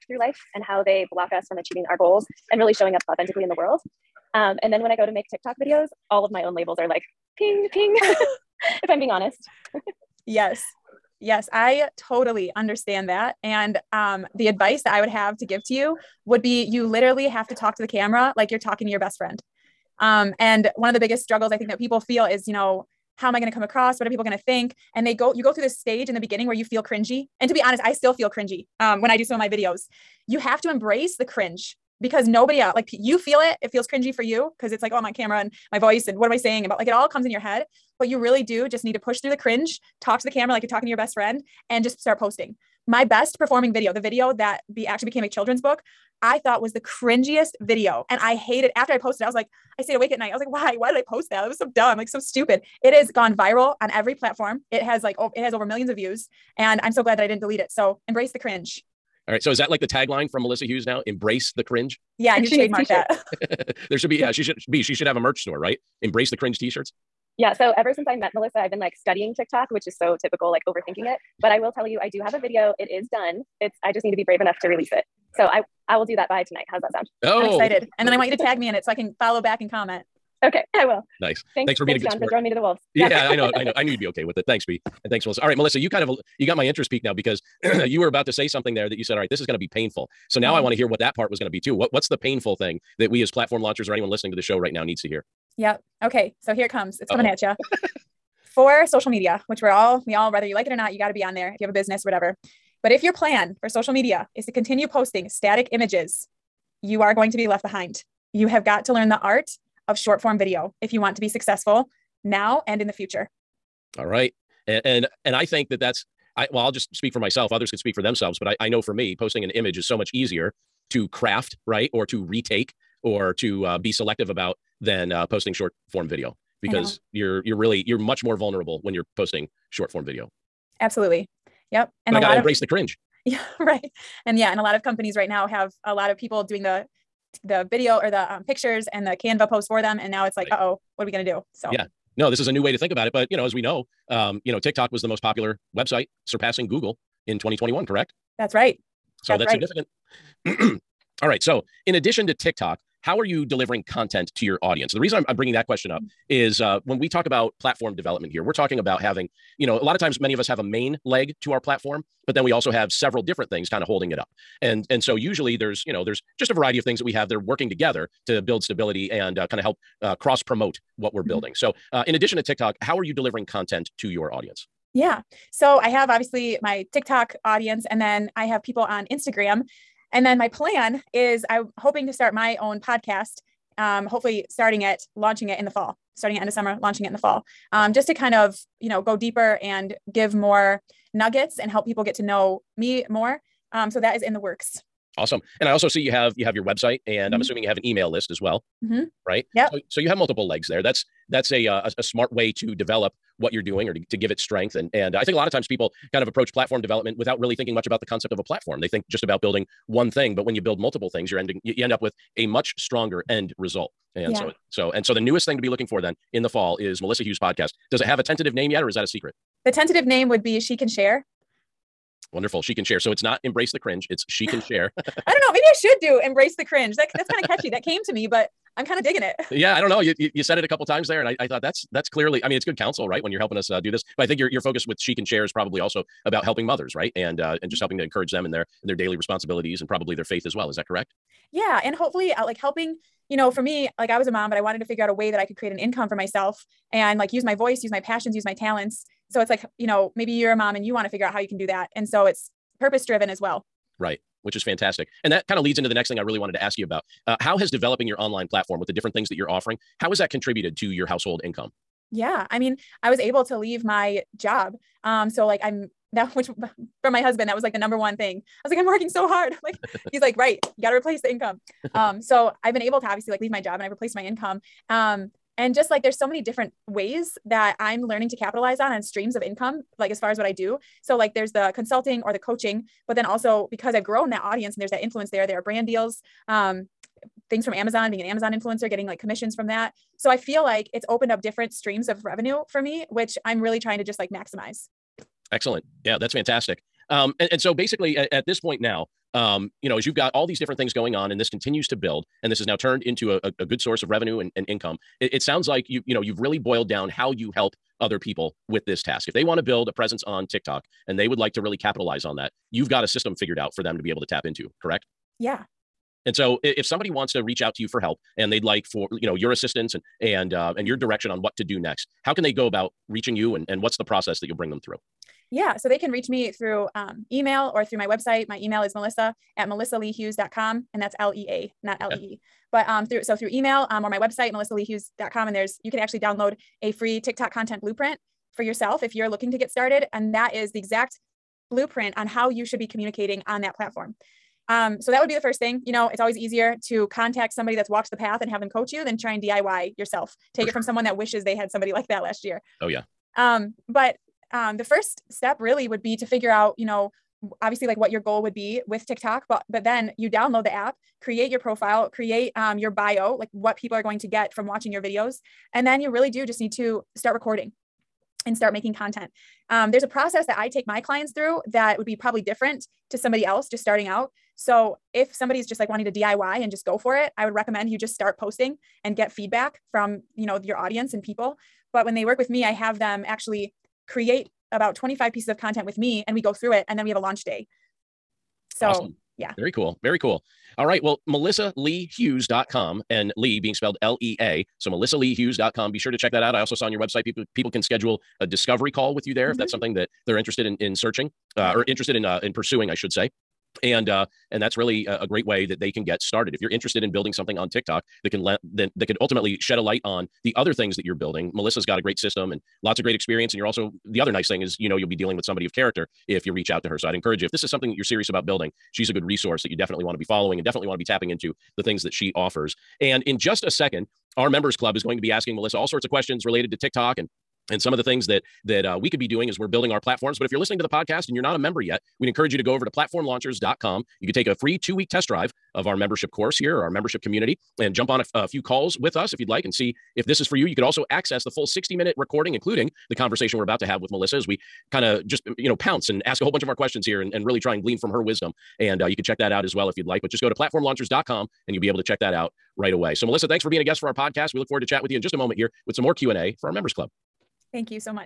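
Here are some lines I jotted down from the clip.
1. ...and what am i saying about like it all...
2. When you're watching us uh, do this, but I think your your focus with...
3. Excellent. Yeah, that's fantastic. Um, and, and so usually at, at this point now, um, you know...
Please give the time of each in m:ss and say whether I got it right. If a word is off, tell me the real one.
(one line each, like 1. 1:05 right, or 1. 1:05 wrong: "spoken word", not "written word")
1. 0:36 right
2. 3:53 wrong: "helping", not "watching"
3. 4:55 wrong: "basically", not "usually".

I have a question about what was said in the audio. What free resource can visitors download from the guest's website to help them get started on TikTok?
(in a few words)
TikTok content blueprint.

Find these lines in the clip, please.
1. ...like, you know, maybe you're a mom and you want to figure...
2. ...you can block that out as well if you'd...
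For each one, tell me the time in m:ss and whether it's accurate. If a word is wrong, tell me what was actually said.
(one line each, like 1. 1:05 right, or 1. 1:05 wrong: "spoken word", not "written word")
1. 4:09 right
2. 7:29 wrong: "check", not "block".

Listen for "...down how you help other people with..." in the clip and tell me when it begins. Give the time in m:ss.
5:06.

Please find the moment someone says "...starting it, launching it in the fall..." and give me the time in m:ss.
3:04.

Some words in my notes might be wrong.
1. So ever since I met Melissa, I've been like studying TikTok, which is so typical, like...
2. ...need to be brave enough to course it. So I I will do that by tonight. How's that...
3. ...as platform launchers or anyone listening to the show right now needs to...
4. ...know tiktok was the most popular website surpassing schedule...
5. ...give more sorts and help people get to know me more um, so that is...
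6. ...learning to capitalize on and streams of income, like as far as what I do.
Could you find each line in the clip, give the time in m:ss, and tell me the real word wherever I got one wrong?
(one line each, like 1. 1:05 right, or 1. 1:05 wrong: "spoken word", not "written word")
1. 1:07 right
2. 1:14 wrong: "release", not "course"
3. 1:33 right
4. 2:24 wrong: "google", not "schedule"
5. 3:10 wrong: "nuggets", not "sorts"
6. 4:38 right.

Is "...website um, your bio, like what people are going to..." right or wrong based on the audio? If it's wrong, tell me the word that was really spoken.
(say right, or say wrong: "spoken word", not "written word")
wrong: "create", not "website".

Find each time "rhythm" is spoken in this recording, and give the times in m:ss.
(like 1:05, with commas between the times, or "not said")
not said.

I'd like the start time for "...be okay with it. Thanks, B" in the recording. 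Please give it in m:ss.
1:23.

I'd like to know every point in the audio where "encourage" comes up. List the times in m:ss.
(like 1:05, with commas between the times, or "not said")
3:58, 6:57, 7:12.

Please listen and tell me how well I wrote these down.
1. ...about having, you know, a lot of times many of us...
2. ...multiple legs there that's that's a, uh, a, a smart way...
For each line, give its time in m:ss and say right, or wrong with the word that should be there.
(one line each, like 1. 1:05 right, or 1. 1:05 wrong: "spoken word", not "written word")
1. 2:38 right
2. 3:20 right.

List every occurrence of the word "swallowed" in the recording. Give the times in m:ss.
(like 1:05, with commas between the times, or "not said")
not said.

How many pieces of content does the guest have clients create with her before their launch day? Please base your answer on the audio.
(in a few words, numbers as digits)
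25.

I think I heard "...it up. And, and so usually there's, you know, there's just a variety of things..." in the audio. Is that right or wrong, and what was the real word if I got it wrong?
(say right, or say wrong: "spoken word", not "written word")
right.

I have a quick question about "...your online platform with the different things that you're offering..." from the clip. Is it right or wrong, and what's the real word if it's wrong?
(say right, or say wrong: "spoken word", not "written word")
right.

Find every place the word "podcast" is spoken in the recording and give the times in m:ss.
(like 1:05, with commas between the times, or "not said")
3:02, 3:37, 7:10, 7:34.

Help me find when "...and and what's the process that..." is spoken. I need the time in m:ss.
5:23.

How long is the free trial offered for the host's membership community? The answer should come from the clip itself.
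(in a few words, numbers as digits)
2 weeks.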